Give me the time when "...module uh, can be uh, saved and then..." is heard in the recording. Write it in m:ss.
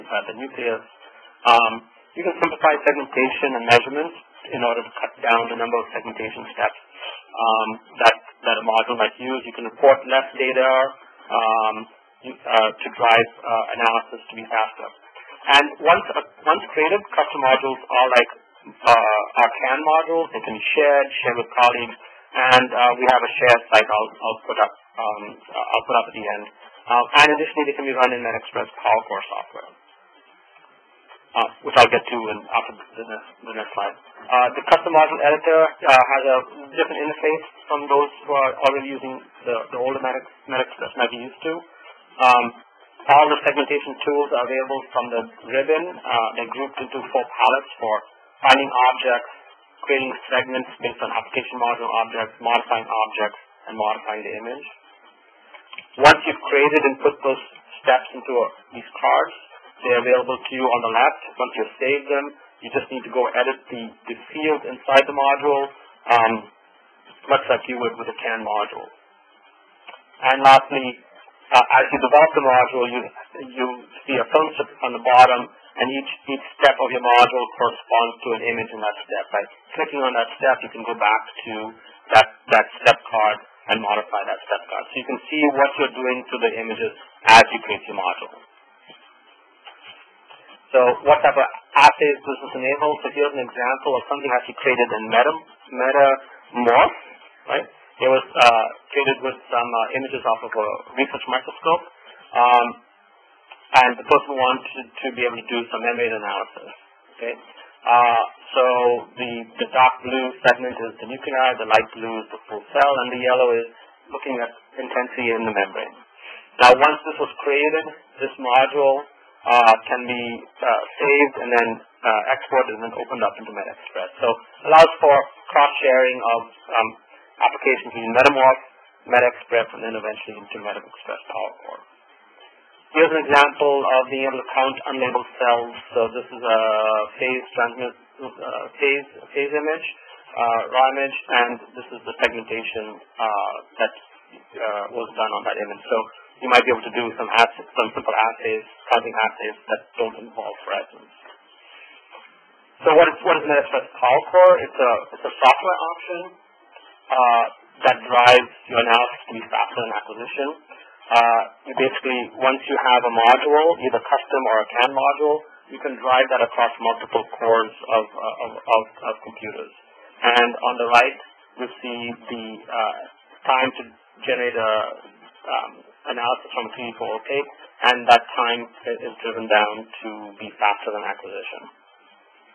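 1:58.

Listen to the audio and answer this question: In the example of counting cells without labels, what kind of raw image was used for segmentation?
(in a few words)
Phase image.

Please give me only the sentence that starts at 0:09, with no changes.
You can report less data um, uh, to drive uh, analysis to be faster.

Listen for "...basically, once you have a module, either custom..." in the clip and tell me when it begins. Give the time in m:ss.
2:41.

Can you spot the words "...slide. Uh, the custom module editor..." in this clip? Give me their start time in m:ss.
0:33.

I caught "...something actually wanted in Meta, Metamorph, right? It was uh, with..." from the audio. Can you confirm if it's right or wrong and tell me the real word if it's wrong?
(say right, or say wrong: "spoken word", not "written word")
wrong: "created", not "wanted".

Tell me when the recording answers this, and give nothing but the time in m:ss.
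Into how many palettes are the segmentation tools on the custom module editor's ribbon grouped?
0:47.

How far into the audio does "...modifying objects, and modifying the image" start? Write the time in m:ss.
0:52.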